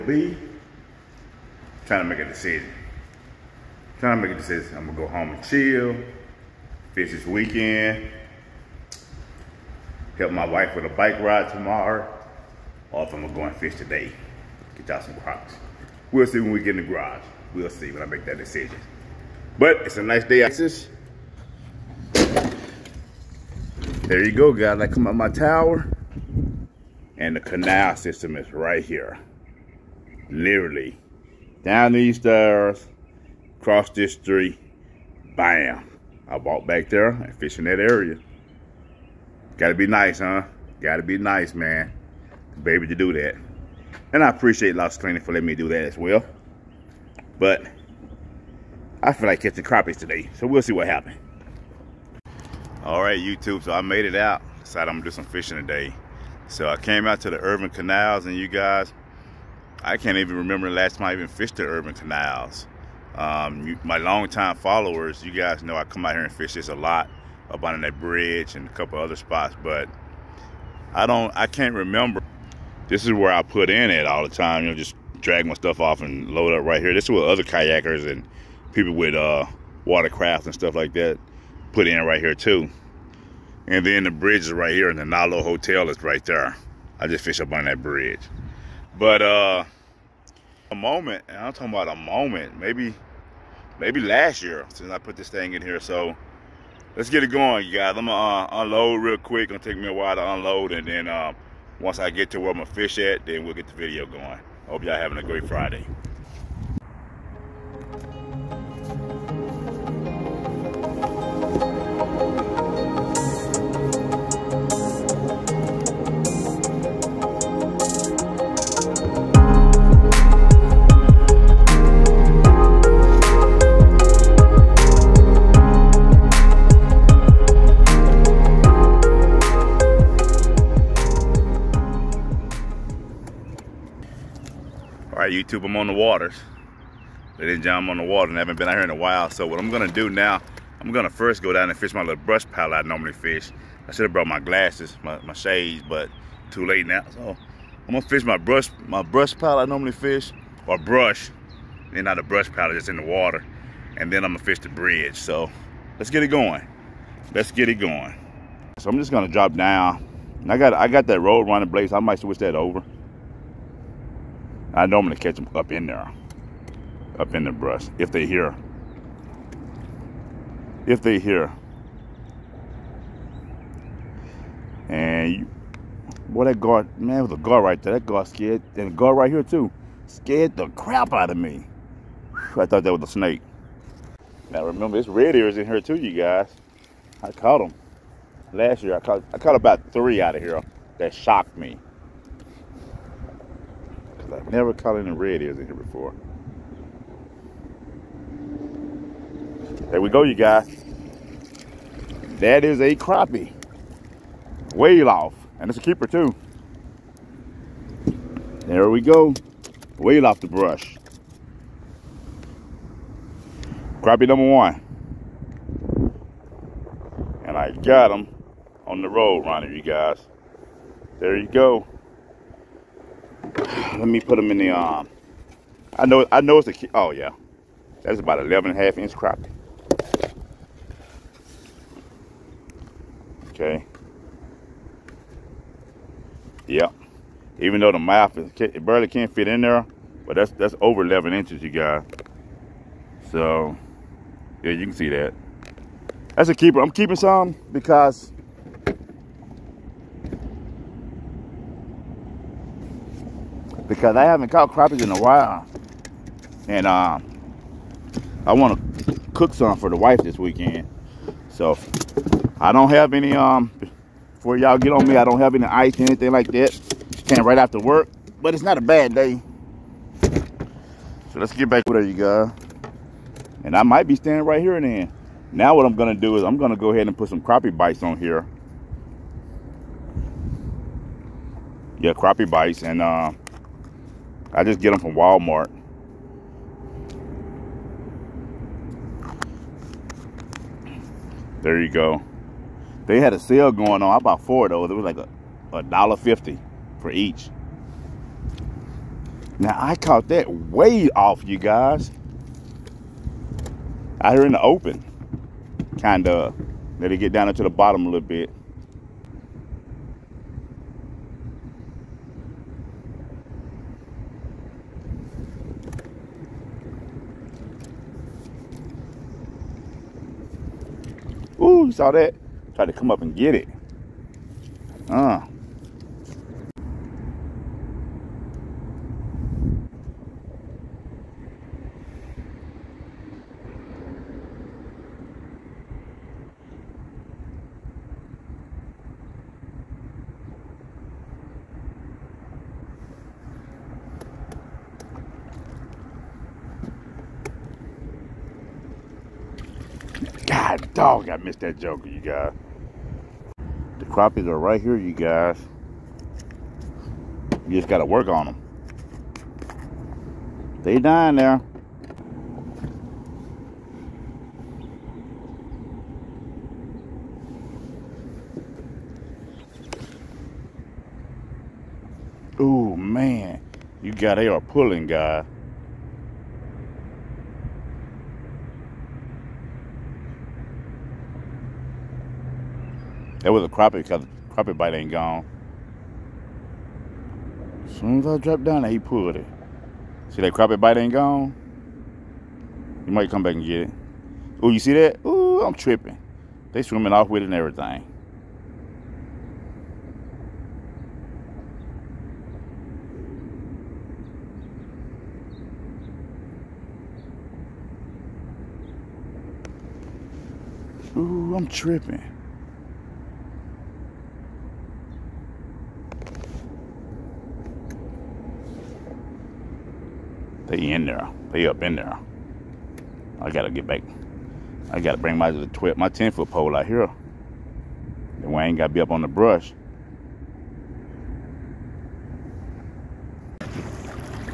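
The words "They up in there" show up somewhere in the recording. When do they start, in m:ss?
7:01.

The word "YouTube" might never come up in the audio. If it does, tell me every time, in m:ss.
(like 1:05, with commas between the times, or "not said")
0:53, 2:15.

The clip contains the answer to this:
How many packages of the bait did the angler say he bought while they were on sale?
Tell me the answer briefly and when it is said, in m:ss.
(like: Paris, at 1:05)
4, at 4:54.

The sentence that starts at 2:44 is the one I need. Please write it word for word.
I normally catch them up in there, up in the brush, if they hear.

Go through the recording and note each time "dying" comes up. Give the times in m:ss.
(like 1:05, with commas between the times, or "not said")
6:00.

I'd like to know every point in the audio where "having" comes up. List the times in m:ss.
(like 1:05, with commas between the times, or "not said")
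1:44.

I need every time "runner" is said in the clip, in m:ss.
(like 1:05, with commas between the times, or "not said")
2:41, 3:39.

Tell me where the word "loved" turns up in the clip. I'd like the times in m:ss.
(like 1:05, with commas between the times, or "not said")
not said.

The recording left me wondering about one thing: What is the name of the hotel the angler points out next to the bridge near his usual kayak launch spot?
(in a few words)
Nalo Hotel.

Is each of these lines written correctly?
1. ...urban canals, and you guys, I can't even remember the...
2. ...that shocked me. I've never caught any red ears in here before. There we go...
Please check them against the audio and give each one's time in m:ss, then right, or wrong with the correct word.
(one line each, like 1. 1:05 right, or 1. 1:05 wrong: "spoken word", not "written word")
1. 0:57 right
2. 3:10 right.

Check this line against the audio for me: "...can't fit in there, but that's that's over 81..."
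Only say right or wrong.
wrong.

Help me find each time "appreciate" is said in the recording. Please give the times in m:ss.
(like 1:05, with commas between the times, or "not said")
0:44.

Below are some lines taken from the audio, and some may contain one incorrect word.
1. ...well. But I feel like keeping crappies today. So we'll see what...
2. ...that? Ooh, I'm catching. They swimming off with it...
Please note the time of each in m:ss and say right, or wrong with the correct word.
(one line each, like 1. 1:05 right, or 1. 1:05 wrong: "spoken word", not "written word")
1. 0:45 wrong: "catching", not "keeping"
2. 6:34 wrong: "tripping", not "catching".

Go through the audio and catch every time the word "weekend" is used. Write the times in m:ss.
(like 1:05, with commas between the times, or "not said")
0:07, 4:20.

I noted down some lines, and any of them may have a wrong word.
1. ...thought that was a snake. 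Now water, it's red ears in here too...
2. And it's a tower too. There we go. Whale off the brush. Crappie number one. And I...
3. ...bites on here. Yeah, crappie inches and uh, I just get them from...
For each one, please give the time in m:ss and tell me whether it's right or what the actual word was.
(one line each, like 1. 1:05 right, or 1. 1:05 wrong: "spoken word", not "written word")
1. 3:02 wrong: "remember", not "water"
2. 3:25 wrong: "keeper", not "tower"
3. 4:37 wrong: "bites", not "inches".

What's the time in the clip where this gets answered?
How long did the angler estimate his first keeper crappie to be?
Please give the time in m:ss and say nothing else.
3:48.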